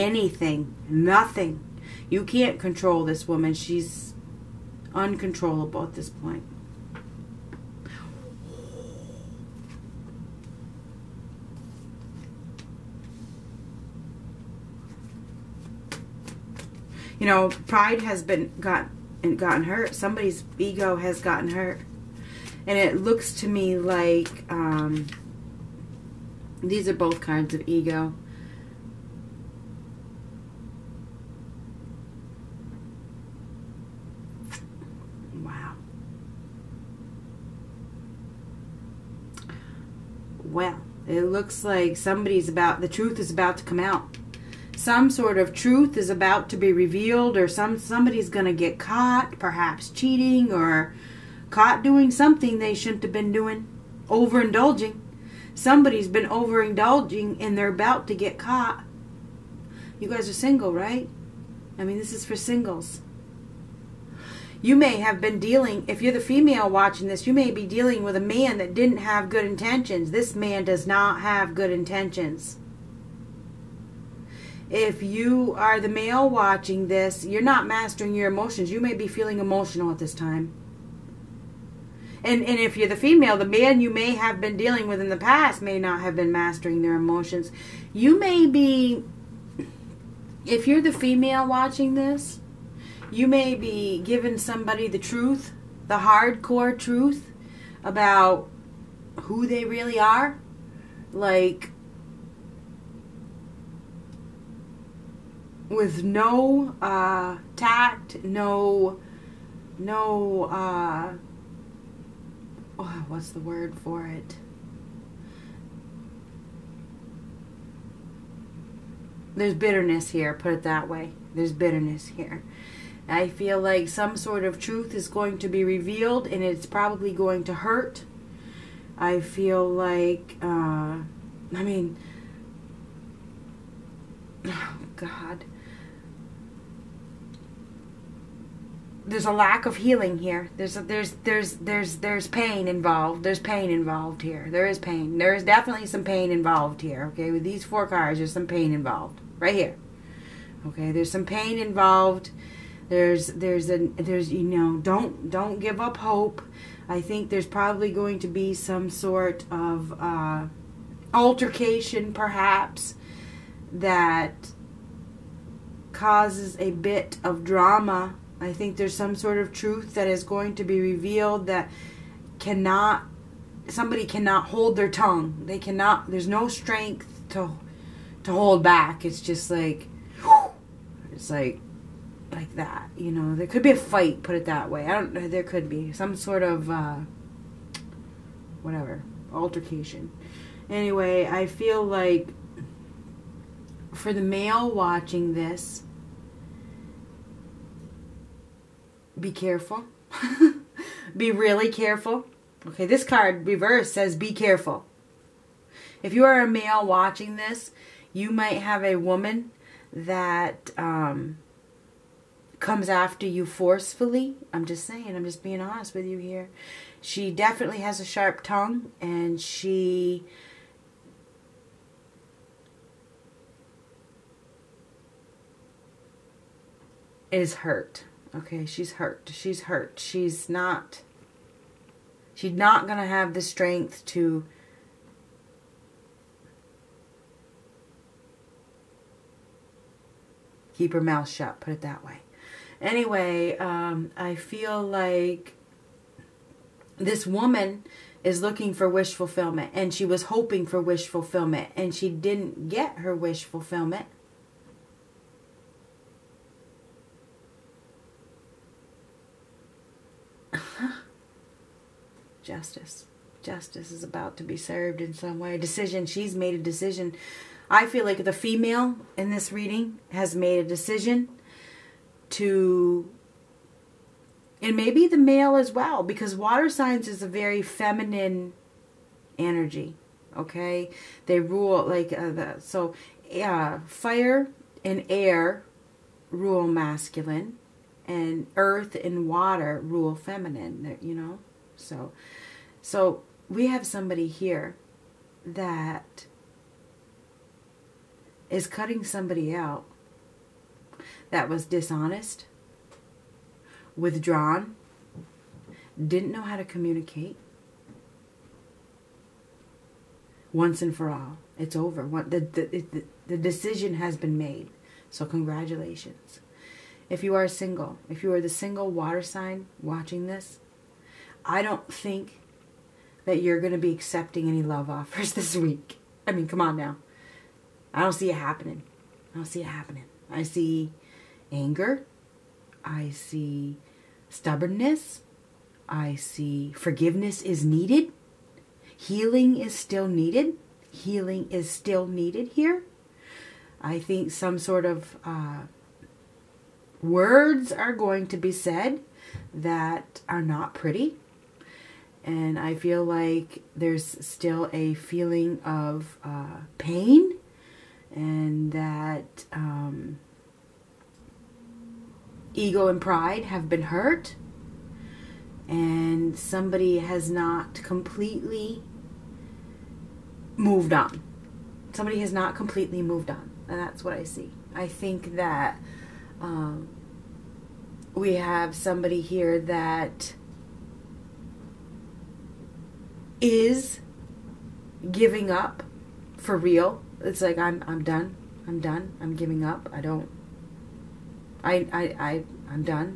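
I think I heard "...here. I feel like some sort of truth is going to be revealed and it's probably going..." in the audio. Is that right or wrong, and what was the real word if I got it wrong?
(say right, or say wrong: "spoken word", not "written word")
right.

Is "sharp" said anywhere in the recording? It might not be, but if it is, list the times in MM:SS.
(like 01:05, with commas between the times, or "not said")
03:38.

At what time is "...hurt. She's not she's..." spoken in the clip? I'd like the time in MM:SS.
03:49.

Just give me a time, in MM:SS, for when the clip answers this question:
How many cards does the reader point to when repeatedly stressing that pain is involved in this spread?
02:27.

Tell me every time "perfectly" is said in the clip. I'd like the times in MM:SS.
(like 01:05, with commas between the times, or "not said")
not said.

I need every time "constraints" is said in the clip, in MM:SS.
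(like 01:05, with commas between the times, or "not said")
not said.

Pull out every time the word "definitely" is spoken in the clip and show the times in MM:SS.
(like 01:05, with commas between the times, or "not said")
02:25, 03:37.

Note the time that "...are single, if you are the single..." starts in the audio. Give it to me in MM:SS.
05:17.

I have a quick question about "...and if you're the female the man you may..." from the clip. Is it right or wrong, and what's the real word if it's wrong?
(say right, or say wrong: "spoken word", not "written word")
right.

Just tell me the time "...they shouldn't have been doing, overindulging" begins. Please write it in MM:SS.
00:52.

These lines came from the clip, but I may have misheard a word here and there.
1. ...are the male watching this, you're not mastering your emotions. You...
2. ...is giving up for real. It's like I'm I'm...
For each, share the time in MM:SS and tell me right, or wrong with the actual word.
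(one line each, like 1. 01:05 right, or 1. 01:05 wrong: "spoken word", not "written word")
1. 01:15 right
2. 06:23 right.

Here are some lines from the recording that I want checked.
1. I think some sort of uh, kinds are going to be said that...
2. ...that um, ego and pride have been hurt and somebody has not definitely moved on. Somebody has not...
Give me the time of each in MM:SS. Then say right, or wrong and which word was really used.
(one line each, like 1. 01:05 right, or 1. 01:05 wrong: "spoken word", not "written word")
1. 05:43 wrong: "words", not "kinds"
2. 05:58 wrong: "completely", not "definitely".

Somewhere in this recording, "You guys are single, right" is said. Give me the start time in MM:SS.
00:59.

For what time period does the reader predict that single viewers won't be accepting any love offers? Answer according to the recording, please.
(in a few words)
this week.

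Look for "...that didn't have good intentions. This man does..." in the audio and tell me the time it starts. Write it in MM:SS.
01:08.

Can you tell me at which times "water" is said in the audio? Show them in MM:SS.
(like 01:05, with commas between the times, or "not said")
04:36, 04:49, 05:18.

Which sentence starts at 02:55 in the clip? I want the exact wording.
They cannot there's no strength to to hold back.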